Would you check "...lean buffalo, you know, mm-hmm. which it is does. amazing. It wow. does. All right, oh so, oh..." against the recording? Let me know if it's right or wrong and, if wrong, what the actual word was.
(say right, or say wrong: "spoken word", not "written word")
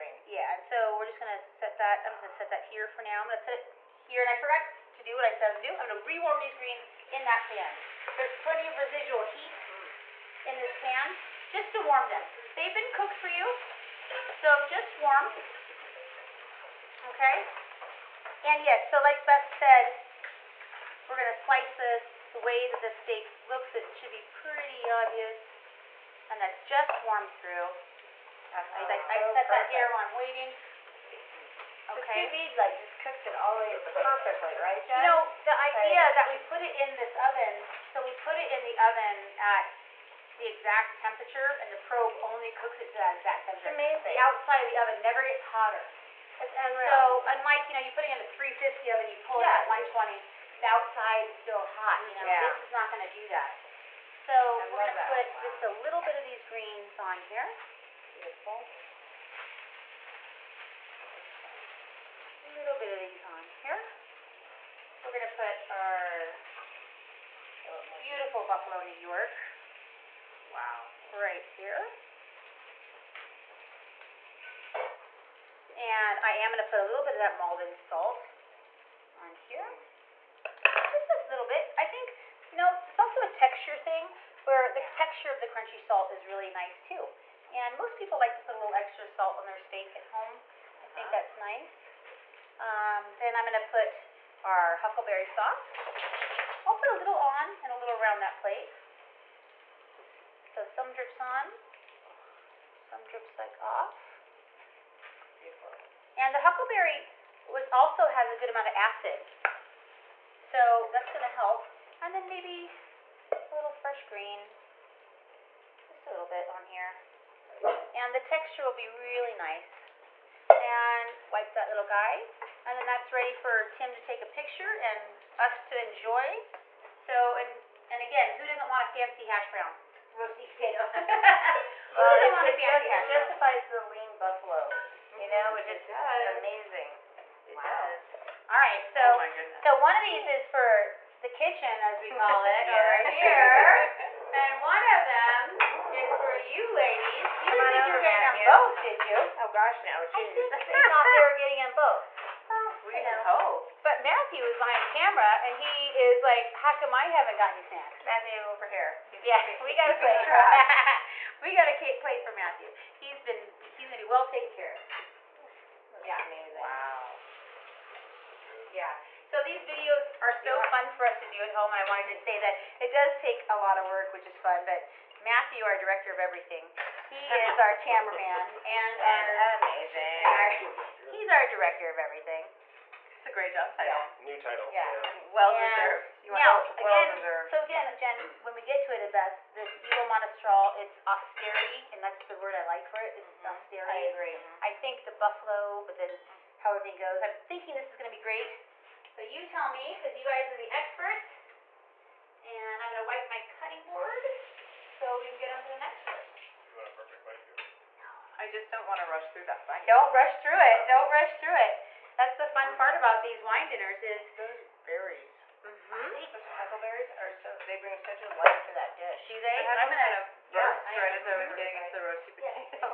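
right.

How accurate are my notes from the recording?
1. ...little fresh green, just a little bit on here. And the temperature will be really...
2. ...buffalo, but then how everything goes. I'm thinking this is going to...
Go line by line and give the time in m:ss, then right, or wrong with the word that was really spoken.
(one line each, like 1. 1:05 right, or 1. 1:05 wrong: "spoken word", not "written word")
1. 1:53 wrong: "texture", not "temperature"
2. 3:15 right.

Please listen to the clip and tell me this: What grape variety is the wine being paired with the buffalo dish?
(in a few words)
Monastrell.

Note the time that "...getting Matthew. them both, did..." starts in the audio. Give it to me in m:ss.
2:27.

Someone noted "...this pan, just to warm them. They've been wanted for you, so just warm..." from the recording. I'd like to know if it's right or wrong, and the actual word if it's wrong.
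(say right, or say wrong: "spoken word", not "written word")
wrong: "cooked", not "wanted".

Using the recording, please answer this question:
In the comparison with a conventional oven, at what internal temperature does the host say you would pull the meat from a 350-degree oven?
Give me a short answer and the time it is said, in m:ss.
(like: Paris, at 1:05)
120, at 0:49.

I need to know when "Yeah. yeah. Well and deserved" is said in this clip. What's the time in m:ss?
3:04.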